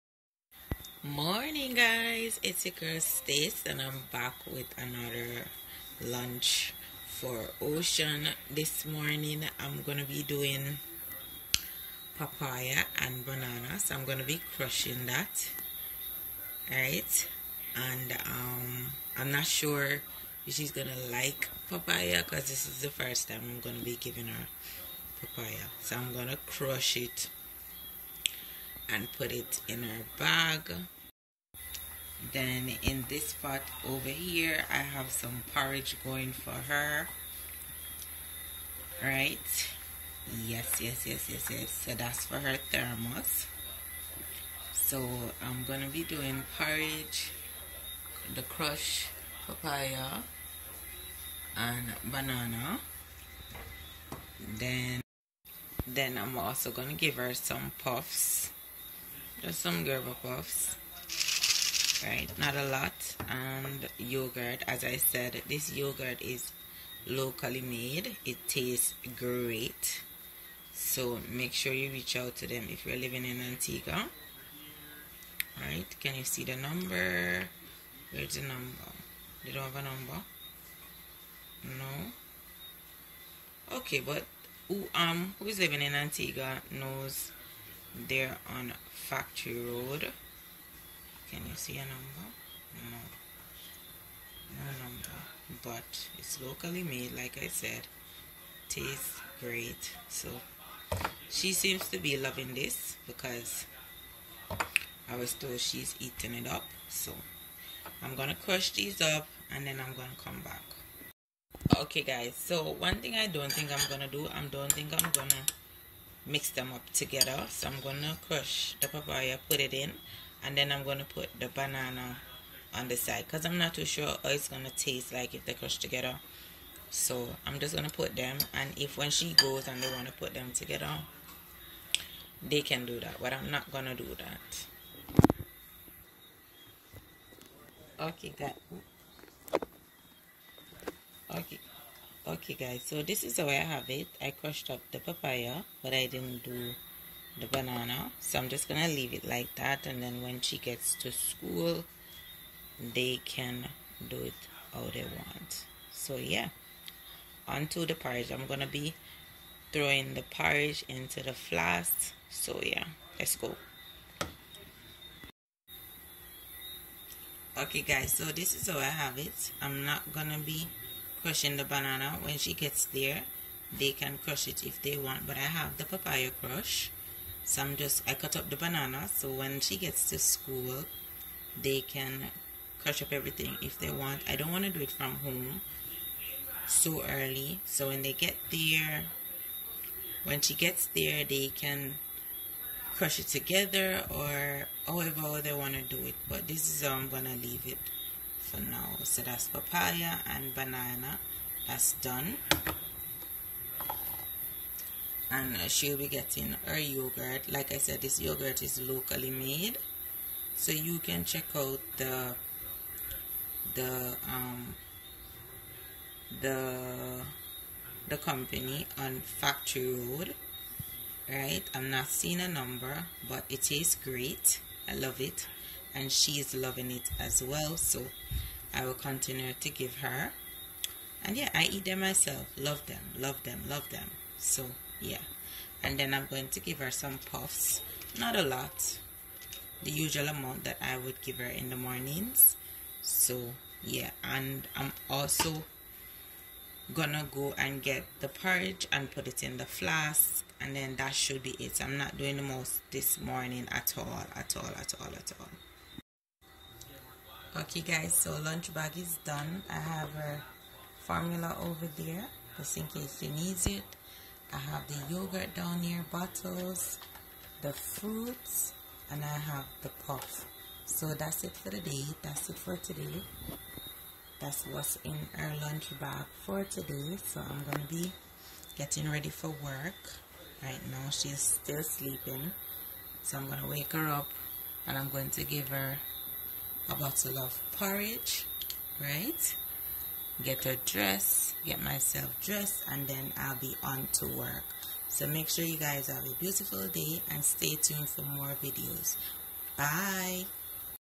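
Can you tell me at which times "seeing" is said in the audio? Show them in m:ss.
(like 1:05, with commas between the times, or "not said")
3:42.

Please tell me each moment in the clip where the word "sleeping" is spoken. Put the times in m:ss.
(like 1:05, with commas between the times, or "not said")
4:41.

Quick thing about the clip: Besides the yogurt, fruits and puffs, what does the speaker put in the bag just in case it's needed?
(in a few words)
formula.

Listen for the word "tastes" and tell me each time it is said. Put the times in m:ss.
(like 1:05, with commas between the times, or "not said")
1:08, 1:38, 2:04, 3:43.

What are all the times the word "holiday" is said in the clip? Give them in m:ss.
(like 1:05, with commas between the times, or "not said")
not said.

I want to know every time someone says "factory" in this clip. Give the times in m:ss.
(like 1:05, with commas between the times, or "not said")
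1:28, 3:39.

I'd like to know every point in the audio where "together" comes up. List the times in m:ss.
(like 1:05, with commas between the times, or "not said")
1:56, 2:05, 2:10, 3:13.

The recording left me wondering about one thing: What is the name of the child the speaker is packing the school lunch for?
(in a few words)
Ocean.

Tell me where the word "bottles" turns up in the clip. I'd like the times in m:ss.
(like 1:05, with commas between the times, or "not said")
4:26, 4:46.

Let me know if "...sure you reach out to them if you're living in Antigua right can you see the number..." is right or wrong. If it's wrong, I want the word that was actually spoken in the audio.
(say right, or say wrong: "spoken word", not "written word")
right.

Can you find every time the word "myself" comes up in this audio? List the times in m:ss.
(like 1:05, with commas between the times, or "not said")
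3:51, 4:51.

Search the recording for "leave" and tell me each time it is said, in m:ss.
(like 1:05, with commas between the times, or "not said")
2:28, 3:17.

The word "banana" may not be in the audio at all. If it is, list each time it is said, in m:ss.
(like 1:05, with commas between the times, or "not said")
0:13, 0:52, 2:01, 2:27, 2:51, 2:58, 3:20.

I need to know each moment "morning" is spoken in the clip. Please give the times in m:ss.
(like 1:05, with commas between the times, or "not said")
0:01, 0:08, 4:01, 4:13.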